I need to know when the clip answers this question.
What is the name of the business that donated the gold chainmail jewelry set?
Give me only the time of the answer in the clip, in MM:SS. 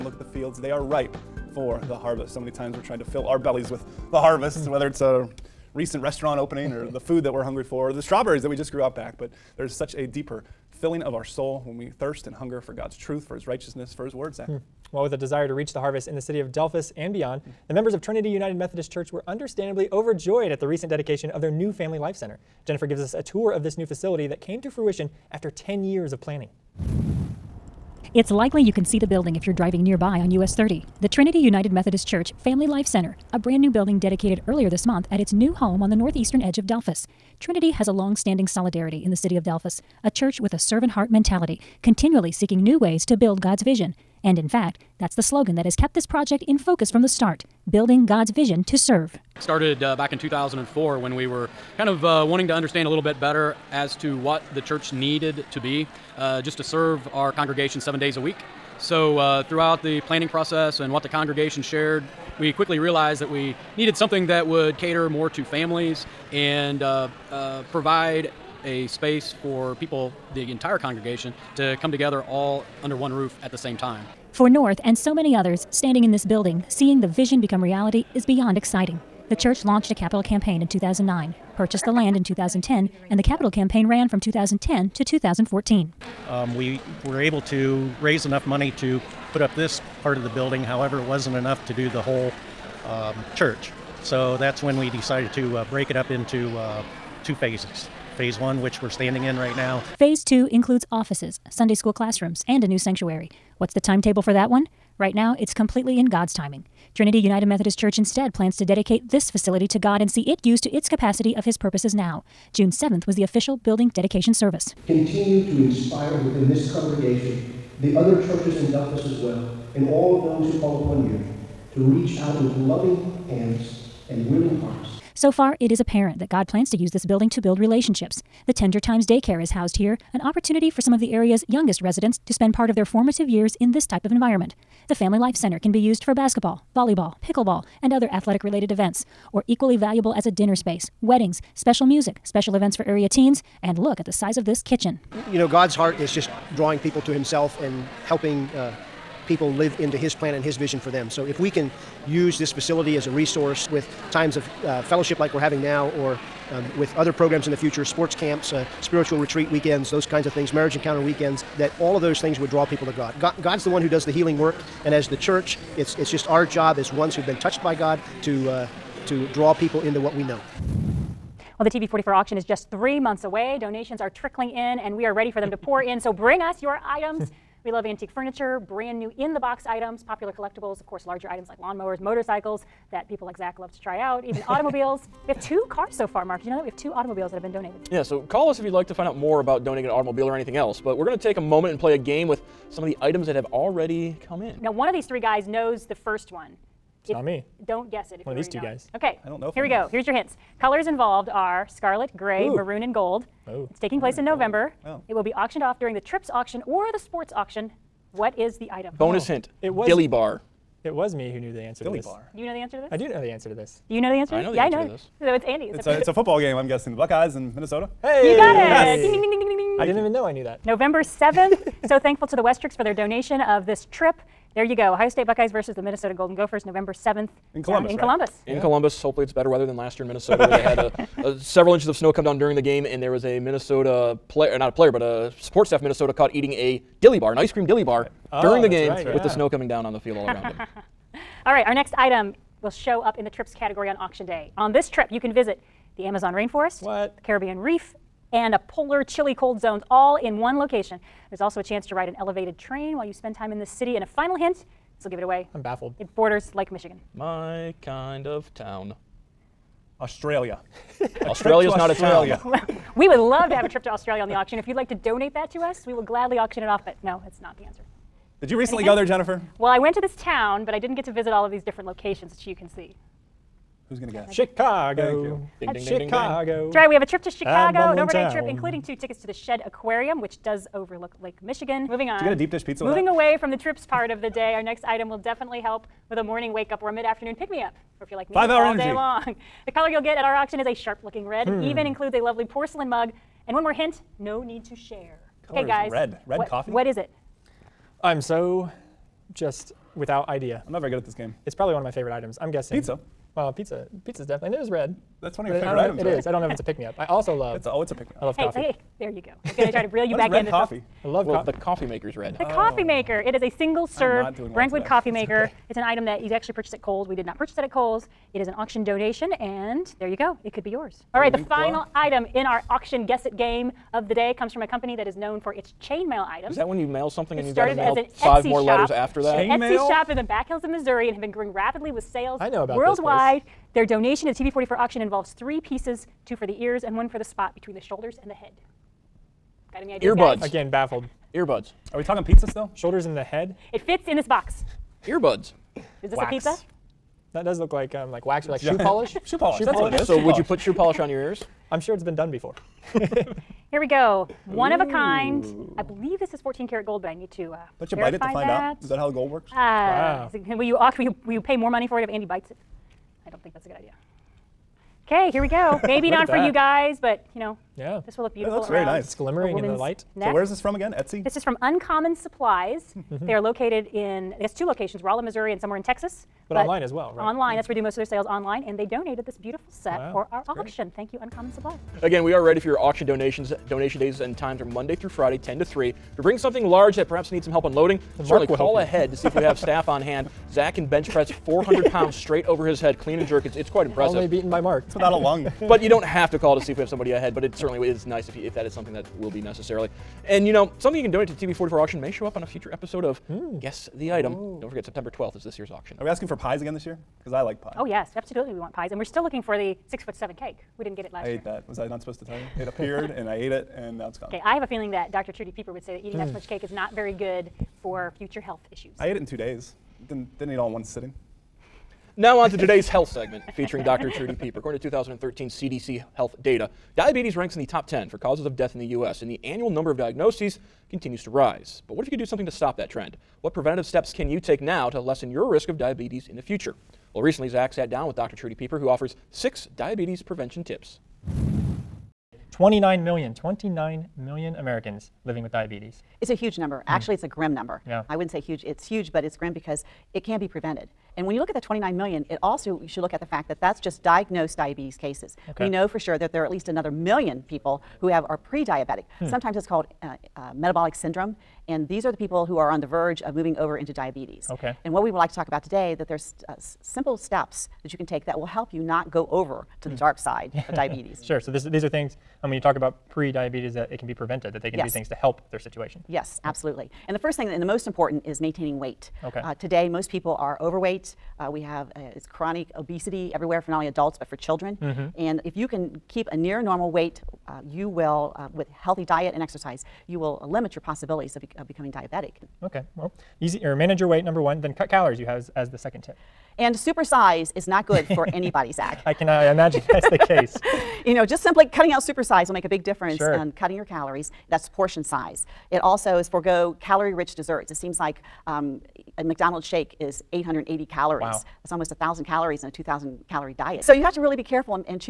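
06:11.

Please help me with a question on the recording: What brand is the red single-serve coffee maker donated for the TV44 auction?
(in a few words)
Brentwood.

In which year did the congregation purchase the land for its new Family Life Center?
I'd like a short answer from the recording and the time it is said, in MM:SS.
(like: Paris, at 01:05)
2010, at 01:21.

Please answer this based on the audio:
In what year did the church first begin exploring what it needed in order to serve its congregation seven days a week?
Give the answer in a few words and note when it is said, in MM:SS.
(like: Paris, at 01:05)
2004, at 00:50.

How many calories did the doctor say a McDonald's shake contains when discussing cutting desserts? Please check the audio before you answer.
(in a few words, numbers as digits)
880.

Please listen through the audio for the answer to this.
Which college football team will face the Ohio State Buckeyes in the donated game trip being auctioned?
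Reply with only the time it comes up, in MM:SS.
03:45.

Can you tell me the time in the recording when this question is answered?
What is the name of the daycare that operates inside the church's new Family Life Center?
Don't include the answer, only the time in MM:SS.
02:08.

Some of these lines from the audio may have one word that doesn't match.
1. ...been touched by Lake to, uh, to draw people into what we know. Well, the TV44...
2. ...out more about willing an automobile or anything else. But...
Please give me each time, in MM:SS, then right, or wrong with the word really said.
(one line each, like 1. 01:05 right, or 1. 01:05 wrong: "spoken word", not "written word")
1. 02:47 wrong: "God", not "Lake"
2. 03:09 wrong: "donating", not "willing".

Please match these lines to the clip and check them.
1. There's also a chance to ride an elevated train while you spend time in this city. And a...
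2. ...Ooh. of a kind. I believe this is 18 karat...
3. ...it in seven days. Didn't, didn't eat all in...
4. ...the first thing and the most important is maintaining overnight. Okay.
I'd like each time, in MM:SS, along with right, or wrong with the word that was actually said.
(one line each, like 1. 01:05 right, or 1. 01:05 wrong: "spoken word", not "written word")
1. 04:11 right
2. 05:54 wrong: "14", not "18"
3. 06:59 wrong: "two", not "seven"
4. 07:57 wrong: "weight", not "overnight".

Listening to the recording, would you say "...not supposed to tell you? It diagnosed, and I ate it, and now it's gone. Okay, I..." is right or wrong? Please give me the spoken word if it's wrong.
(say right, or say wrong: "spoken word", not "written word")
wrong: "appeared", not "diagnosed".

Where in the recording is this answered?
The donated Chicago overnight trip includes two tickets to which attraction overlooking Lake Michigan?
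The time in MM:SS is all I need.
04:39.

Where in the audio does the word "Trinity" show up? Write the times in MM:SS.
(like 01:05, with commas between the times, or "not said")
00:18, 00:31, 00:37, 01:46.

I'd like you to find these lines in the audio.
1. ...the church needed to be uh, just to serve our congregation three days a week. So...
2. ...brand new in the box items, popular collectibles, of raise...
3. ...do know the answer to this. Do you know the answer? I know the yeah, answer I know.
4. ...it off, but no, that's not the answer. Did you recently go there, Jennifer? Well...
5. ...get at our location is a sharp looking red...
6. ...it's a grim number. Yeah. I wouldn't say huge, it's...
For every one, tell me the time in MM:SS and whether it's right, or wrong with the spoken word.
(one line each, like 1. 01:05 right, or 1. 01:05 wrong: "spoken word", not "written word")
1. 00:54 wrong: "seven", not "three"
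2. 02:58 wrong: "course", not "raise"
3. 03:32 right
4. 04:26 right
5. 04:50 wrong: "auction", not "location"
6. 07:27 right.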